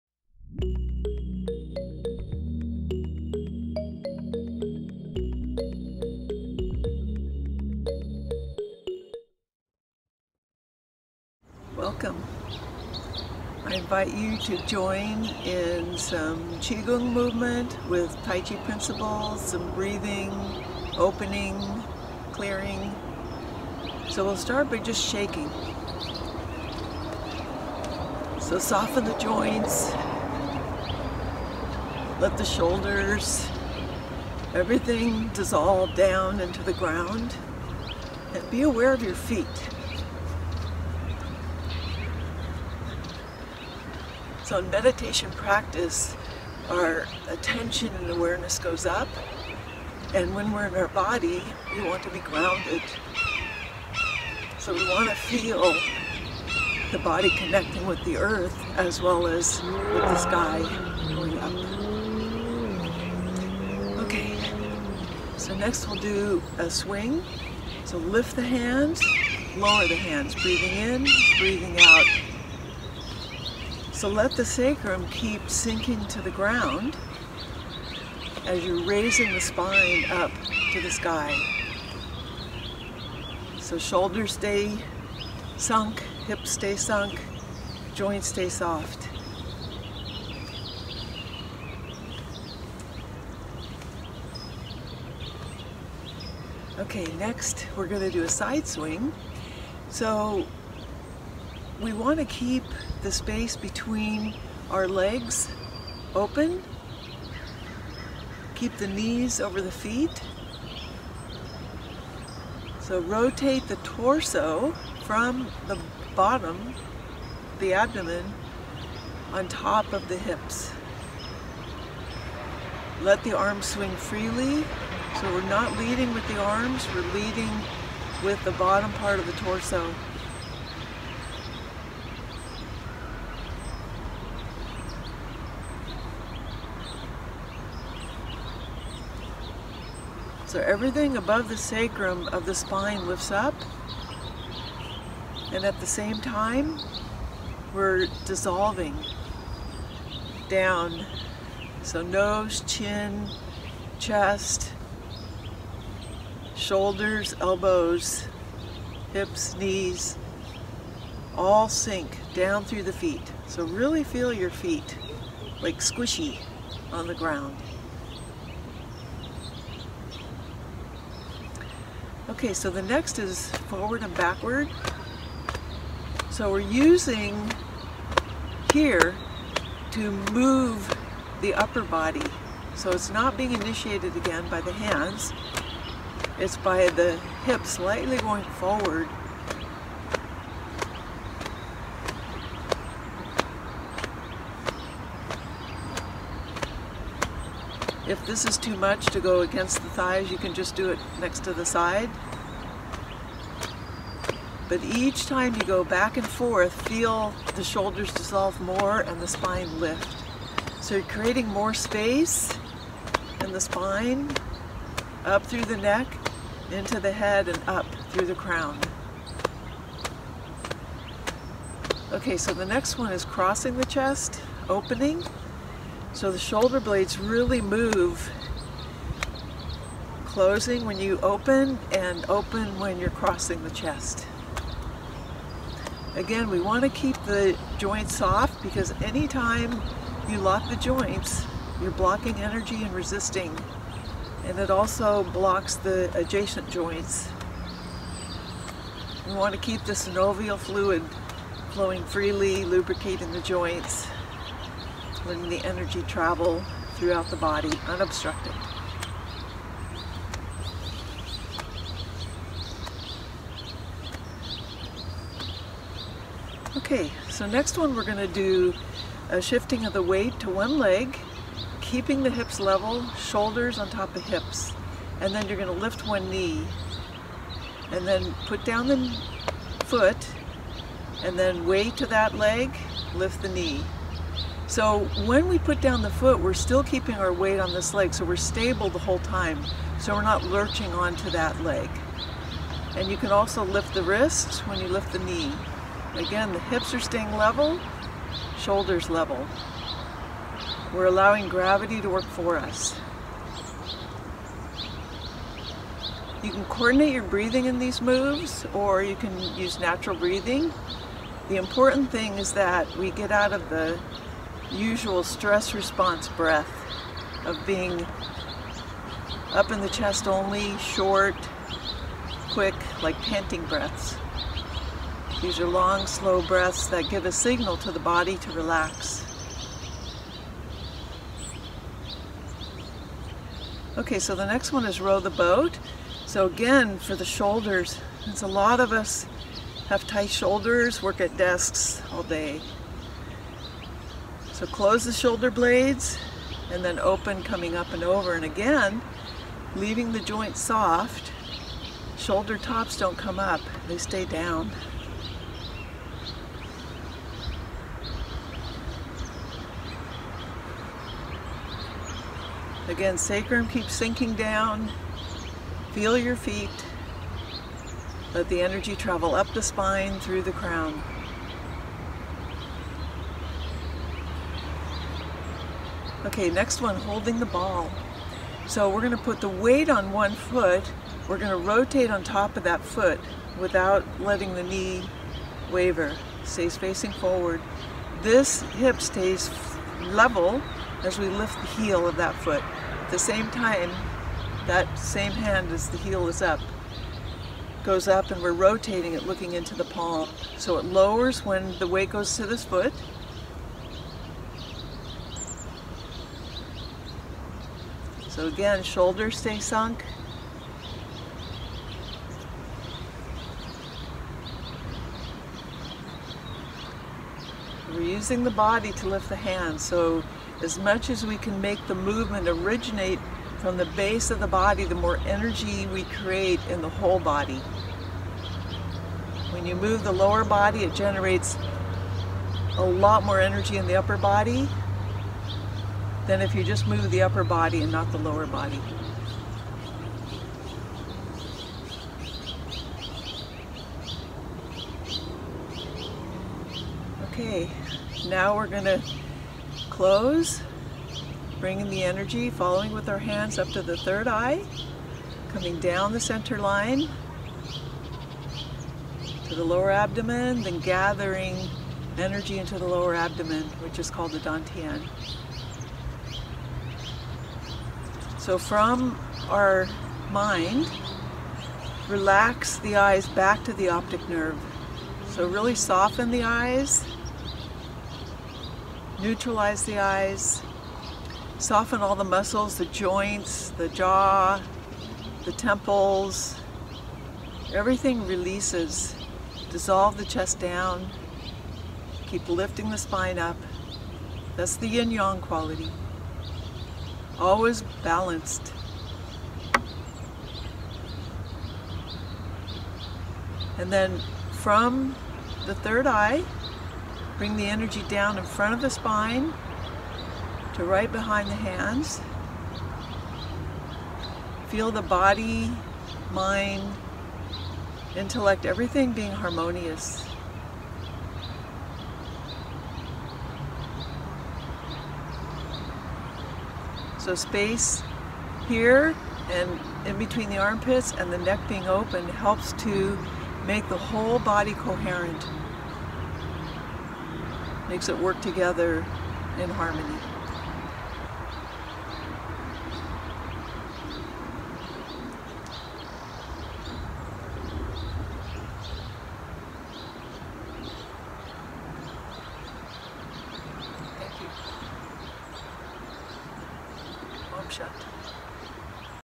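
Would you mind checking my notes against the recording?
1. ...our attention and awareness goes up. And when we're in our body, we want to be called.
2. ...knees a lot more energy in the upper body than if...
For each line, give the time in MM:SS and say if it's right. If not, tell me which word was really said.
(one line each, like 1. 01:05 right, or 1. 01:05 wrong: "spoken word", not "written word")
1. 00:46 wrong: "grounded", not "called"
2. 07:10 wrong: "generates", not "knees".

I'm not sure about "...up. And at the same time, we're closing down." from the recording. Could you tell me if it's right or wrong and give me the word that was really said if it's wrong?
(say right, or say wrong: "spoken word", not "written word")
wrong: "dissolving", not "closing".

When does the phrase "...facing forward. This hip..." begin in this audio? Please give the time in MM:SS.
06:26.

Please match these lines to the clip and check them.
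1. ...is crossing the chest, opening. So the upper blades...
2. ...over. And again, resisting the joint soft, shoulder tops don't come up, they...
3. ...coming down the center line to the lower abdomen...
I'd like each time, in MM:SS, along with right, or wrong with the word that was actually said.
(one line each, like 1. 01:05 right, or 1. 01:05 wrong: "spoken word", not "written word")
1. 03:43 wrong: "shoulder", not "upper"
2. 05:48 wrong: "leaving", not "resisting"
3. 07:35 right.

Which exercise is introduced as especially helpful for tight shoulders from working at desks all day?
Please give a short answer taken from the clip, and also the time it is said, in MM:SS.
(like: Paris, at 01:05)
Row the boat, at 05:35.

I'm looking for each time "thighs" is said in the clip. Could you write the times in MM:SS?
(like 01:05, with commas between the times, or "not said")
03:19.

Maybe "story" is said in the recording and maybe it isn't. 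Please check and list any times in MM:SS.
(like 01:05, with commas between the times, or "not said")
not said.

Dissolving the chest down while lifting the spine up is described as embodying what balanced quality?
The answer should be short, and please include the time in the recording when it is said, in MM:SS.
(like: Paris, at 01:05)
yin yang, at 08:14.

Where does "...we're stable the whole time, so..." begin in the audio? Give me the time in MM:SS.
04:48.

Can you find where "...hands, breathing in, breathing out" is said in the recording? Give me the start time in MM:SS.
01:09.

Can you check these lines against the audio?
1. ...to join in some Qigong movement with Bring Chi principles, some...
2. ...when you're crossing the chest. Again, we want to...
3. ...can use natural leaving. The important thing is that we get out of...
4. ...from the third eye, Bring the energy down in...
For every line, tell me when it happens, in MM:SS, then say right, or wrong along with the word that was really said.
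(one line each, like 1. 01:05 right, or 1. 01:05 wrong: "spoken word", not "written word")
1. 00:14 wrong: "Tai", not "Bring"
2. 03:52 right
3. 05:09 wrong: "breathing", not "leaving"
4. 08:24 right.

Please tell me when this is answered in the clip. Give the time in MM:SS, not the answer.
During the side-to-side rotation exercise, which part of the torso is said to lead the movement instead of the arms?
02:08.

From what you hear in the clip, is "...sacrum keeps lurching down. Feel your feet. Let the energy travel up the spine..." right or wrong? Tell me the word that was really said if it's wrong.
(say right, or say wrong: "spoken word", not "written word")
wrong: "sinking", not "lurching".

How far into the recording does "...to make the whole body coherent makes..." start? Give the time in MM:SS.
08:52.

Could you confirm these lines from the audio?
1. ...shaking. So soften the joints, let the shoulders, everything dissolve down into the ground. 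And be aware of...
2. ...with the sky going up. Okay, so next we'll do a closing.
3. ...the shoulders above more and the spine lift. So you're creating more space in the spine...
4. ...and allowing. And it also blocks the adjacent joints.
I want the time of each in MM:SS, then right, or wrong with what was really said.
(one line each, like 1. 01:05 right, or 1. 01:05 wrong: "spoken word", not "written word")
1. 00:25 right
2. 00:59 wrong: "swing", not "closing"
3. 03:27 wrong: "dissolve", not "above"
4. 04:02 wrong: "resisting", not "allowing".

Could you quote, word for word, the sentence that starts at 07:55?
So really soften the eyes, neutralize the eyes, soften all the muscles, the joints, the jaw, the temples.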